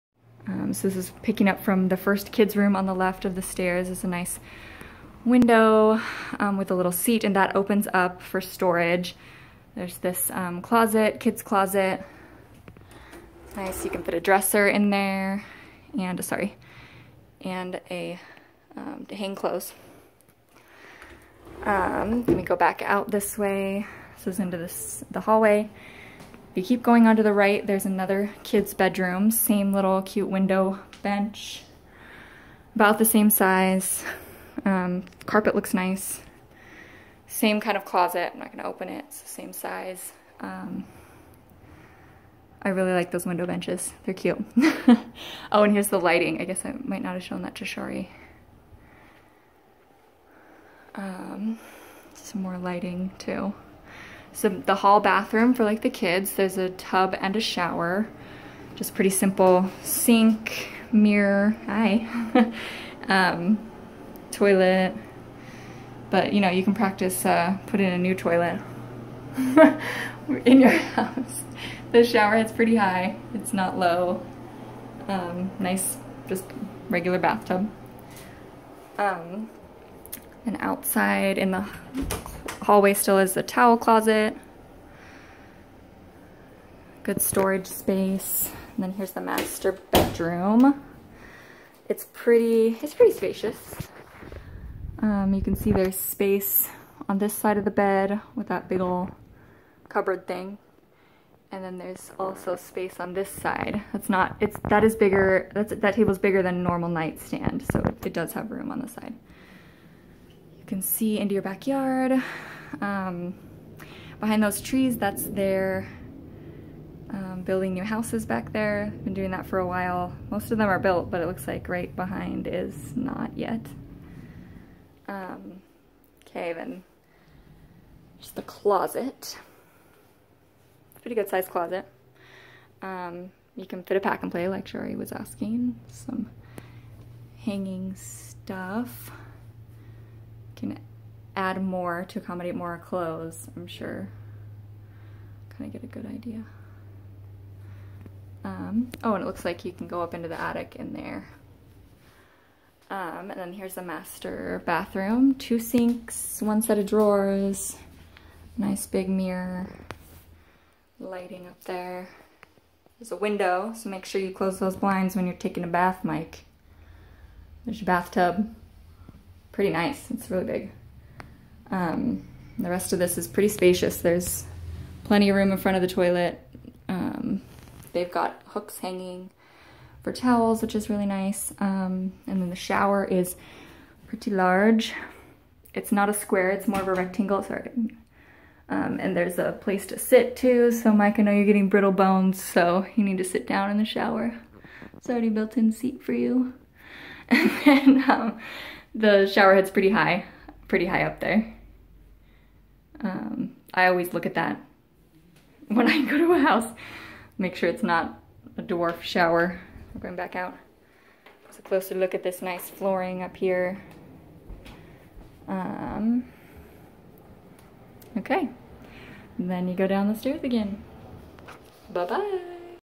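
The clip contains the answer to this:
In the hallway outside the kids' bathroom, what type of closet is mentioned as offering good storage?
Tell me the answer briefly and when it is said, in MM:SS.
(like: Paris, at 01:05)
Towel closet, at 01:23.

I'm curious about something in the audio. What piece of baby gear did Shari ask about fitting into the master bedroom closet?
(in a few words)
Pack and play.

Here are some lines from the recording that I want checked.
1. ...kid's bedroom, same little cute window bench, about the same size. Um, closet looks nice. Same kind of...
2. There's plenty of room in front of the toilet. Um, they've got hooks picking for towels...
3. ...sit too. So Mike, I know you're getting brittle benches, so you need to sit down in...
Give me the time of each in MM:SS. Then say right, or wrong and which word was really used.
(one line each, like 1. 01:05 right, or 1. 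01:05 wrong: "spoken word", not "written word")
1. 00:28 wrong: "carpet", not "closet"
2. 02:54 wrong: "hanging", not "picking"
3. 03:09 wrong: "bones", not "benches".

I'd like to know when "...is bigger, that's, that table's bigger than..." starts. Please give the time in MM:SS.
01:44.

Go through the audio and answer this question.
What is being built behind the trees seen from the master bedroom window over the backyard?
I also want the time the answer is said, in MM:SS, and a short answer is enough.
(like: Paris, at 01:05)
New houses, at 01:57.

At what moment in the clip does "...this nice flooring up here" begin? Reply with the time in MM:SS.
03:32.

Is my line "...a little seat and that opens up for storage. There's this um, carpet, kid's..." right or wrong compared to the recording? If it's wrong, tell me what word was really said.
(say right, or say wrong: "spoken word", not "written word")
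wrong: "closet", not "carpet".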